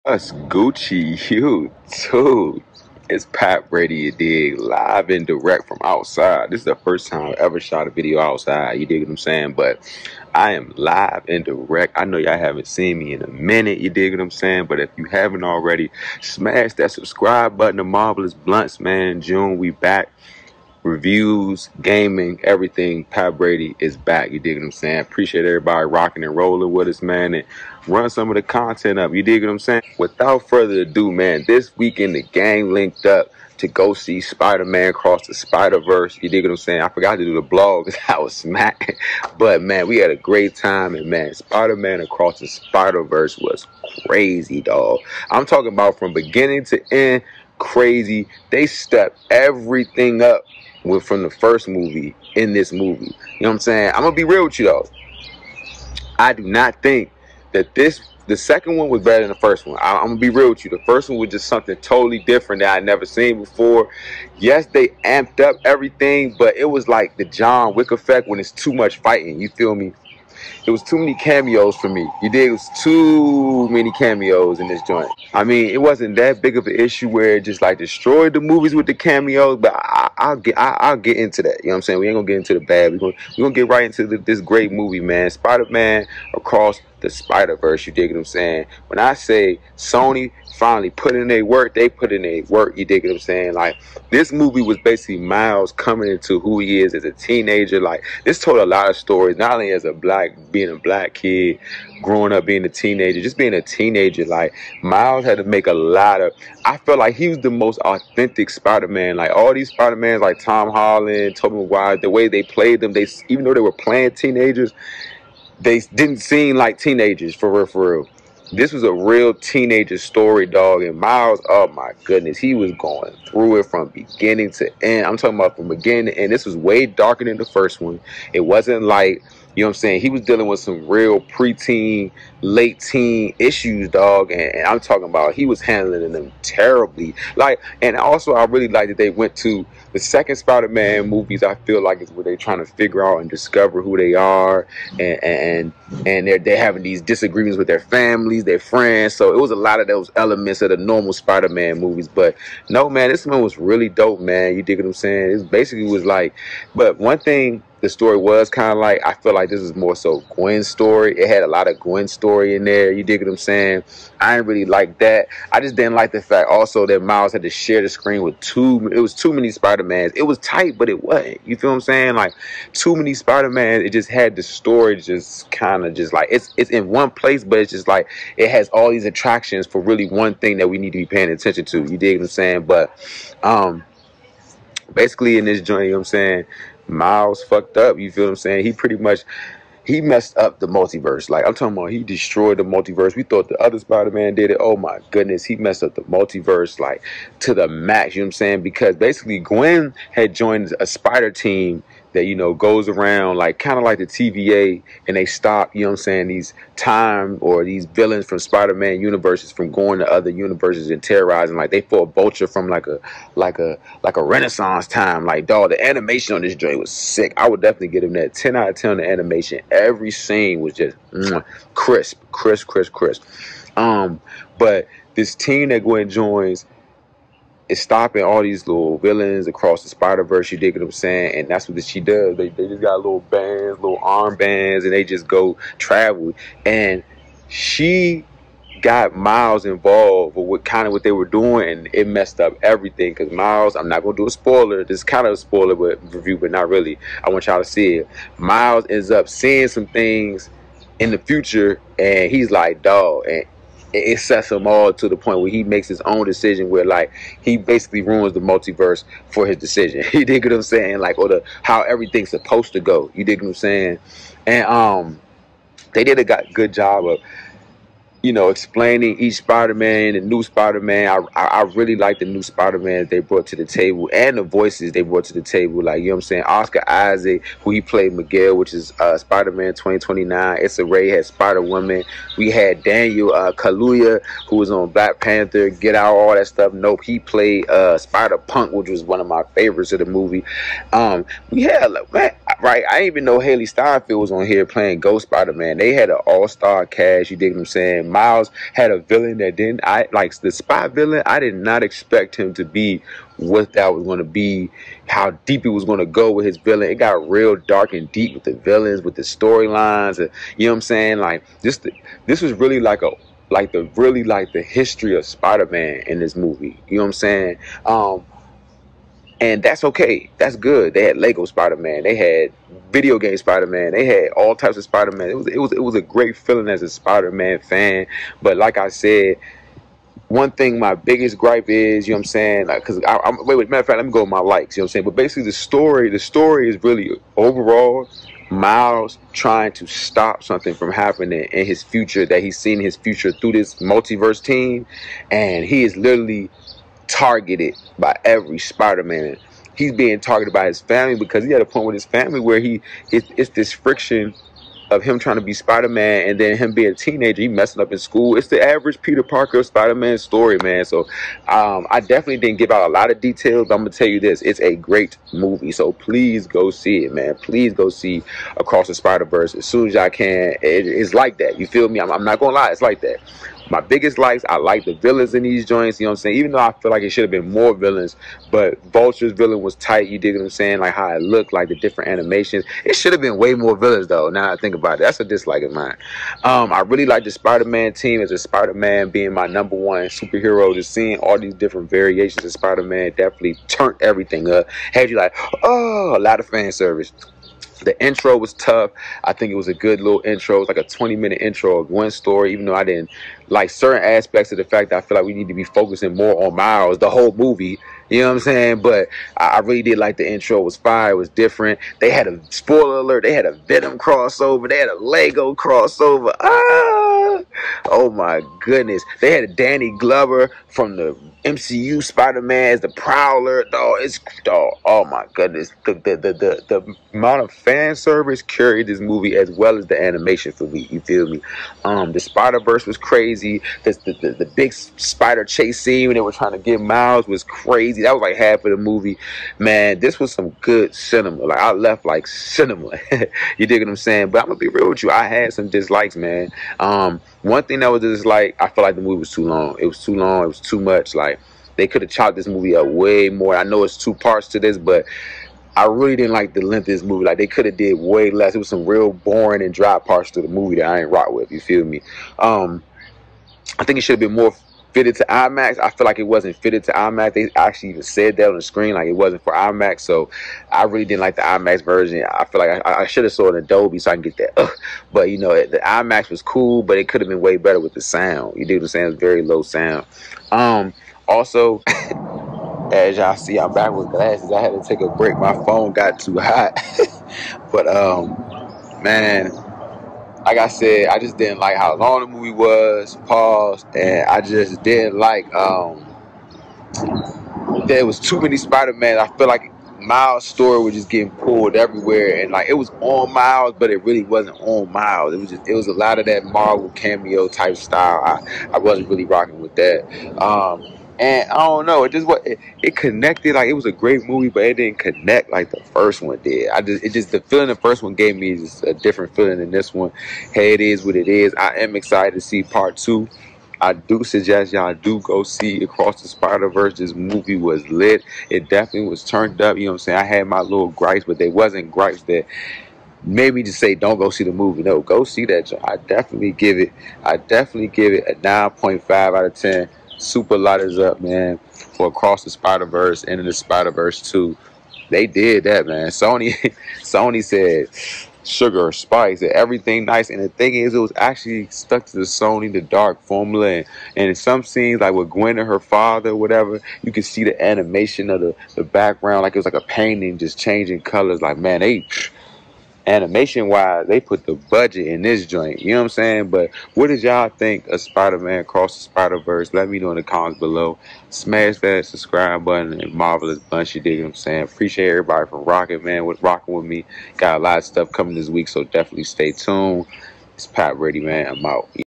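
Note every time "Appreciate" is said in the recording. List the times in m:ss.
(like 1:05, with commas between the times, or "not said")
0:25, 9:34.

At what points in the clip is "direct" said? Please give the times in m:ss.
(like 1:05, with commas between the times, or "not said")
0:05, 0:11.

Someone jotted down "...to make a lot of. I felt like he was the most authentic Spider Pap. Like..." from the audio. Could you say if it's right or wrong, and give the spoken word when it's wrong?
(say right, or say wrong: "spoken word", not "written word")
wrong: "Man", not "Pap".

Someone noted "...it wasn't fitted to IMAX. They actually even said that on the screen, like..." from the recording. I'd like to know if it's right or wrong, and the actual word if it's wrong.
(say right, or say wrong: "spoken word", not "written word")
right.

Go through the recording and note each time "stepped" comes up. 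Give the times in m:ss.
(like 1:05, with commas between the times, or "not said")
0:48.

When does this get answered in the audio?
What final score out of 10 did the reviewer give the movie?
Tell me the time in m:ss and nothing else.
8:58.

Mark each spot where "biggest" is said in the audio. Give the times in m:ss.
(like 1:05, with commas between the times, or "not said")
5:30, 6:13.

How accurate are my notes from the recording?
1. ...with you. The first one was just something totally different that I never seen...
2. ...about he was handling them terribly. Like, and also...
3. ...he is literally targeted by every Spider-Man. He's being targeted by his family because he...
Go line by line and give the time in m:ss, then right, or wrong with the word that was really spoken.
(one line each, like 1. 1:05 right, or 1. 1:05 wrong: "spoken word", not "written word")
1. 1:00 right
2. 2:15 right
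3. 5:45 right.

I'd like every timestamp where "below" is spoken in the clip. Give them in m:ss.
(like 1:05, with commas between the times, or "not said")
9:30.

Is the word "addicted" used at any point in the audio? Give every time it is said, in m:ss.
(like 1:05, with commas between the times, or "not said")
not said.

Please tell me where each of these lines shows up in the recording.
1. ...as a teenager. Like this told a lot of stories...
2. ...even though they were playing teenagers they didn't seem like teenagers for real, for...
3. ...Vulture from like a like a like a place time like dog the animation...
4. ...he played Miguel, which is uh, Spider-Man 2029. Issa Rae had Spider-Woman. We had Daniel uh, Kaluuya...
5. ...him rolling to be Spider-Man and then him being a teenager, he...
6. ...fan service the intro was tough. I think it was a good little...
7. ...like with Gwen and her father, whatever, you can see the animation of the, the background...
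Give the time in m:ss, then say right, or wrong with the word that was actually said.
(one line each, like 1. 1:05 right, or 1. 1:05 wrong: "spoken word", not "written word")
1. 1:36 right
2. 1:53 right
3. 3:32 wrong: "renaissance", not "place"
4. 4:37 right
5. 5:55 wrong: "trying", not "rolling"
6. 6:36 right
7. 9:15 right.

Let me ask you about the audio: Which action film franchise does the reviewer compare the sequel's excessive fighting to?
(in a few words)
John Wick.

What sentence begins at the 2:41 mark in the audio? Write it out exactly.
It had a lot of Gwen's story in there.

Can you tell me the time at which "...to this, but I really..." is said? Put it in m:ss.
7:34.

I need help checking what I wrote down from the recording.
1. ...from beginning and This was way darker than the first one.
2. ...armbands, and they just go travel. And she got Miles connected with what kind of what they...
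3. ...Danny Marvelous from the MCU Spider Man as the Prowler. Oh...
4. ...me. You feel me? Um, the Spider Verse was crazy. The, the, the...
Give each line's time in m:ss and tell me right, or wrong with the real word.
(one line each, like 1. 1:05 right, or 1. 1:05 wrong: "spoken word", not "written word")
1. 2:05 right
2. 3:53 wrong: "involved", not "connected"
3. 6:59 wrong: "Glover", not "Marvelous"
4. 7:10 right.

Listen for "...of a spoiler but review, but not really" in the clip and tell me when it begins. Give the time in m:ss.
4:05.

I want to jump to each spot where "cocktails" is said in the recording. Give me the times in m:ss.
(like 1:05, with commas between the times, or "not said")
not said.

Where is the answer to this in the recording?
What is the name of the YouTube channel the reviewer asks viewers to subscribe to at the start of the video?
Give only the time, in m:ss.
0:17.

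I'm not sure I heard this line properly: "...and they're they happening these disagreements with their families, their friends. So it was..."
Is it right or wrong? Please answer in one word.
wrong.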